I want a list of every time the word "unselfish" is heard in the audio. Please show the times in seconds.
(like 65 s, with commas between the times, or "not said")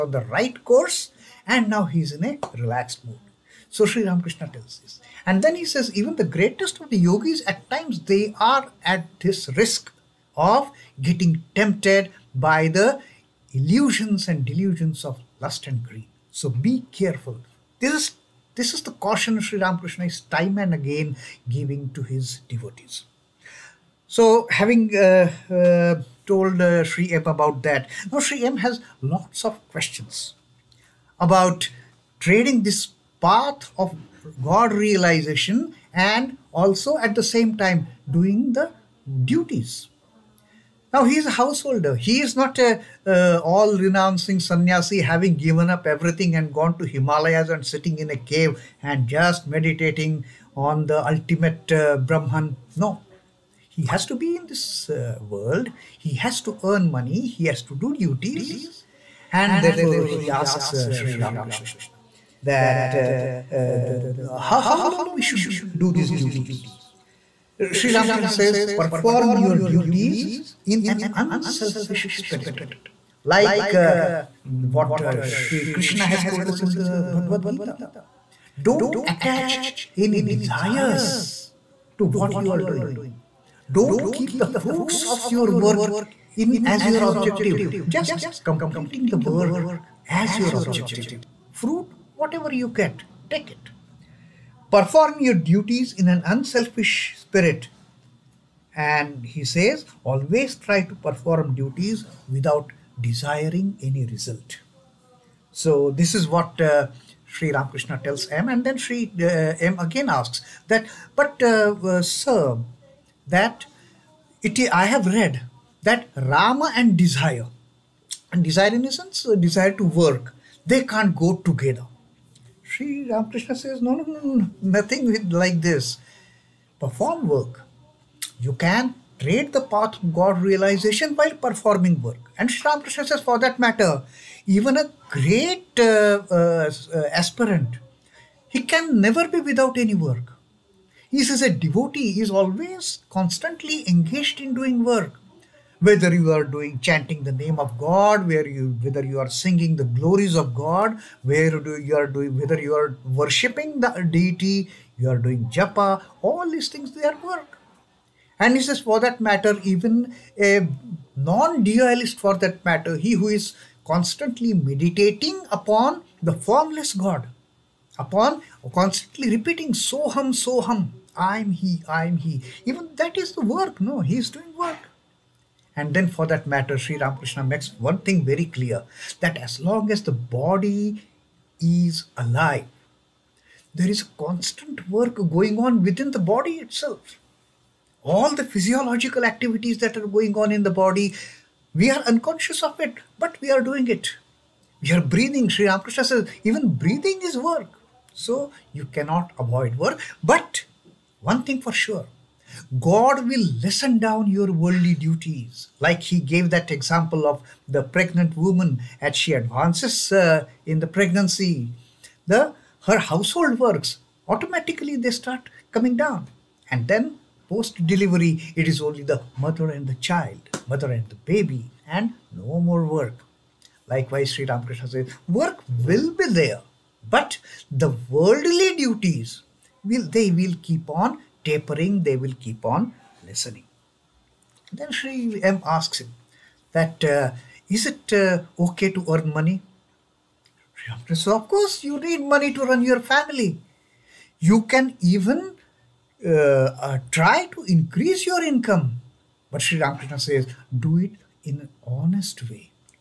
71 s, 96 s.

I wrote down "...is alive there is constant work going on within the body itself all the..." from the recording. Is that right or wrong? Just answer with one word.
right.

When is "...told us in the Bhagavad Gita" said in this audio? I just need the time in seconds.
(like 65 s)
76 s.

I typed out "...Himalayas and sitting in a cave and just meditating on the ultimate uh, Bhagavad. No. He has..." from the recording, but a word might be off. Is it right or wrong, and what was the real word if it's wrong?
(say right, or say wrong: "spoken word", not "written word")
wrong: "Brahman", not "Bhagavad".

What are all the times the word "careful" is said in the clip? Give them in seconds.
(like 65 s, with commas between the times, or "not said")
16 s.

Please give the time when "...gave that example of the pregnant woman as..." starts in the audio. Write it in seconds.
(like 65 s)
206 s.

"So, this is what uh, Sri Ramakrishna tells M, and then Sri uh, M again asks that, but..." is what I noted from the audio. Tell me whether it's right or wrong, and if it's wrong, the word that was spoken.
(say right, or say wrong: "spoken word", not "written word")
right.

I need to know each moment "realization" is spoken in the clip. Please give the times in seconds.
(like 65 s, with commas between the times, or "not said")
34 s, 130 s.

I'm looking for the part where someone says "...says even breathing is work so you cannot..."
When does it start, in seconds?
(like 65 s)
196 s.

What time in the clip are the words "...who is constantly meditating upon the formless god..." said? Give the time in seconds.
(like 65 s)
163 s.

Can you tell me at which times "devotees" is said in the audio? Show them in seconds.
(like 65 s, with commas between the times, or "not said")
22 s, 141 s.